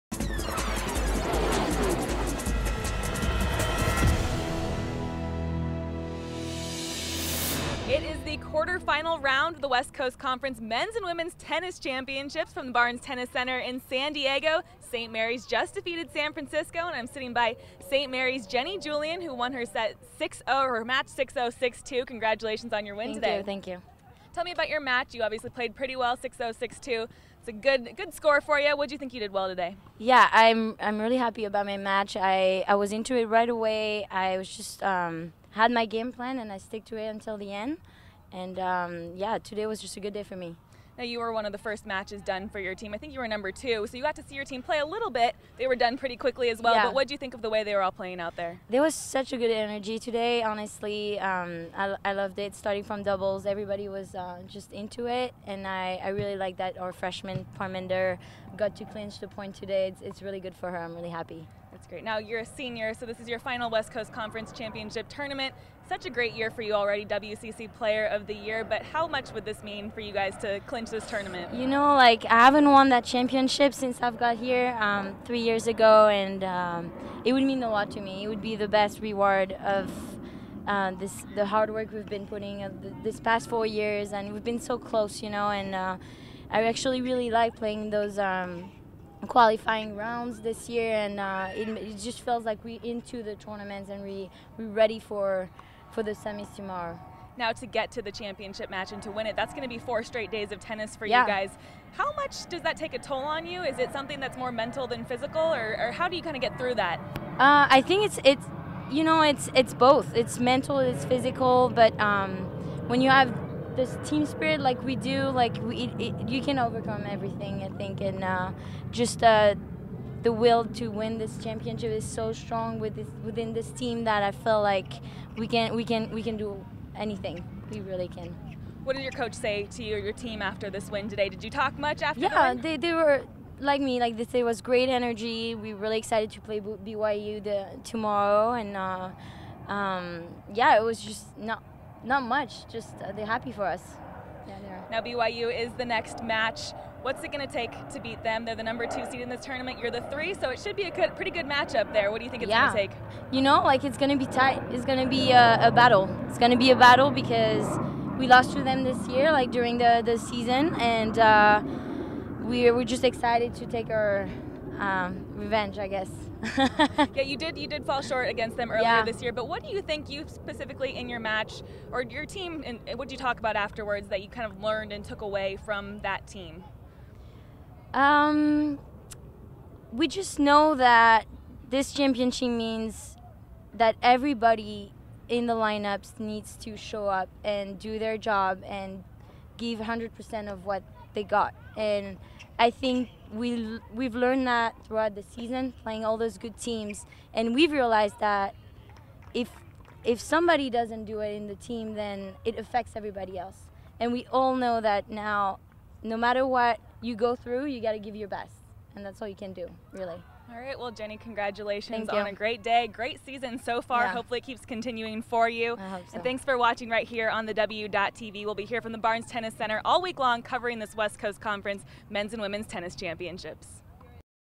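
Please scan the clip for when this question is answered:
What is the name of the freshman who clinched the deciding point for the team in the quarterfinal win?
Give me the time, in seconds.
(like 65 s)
57 s.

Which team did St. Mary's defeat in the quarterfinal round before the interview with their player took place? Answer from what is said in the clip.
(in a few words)
San Francisco.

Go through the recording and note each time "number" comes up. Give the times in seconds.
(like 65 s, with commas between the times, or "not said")
43 s, 148 s.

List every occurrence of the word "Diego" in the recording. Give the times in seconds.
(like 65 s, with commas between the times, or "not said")
14 s.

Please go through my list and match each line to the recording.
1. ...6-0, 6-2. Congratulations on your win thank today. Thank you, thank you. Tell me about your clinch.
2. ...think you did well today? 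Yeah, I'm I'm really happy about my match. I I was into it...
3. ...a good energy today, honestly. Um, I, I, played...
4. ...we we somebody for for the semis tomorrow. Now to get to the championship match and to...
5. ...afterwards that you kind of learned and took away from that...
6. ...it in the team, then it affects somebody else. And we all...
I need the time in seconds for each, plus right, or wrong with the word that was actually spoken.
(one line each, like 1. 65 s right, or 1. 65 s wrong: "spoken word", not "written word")
1. 21 s wrong: "match", not "clinch"
2. 28 s right
3. 49 s wrong: "loved", not "played"
4. 94 s wrong: "ready", not "somebody"
5. 173 s right
6. 201 s wrong: "everybody", not "somebody".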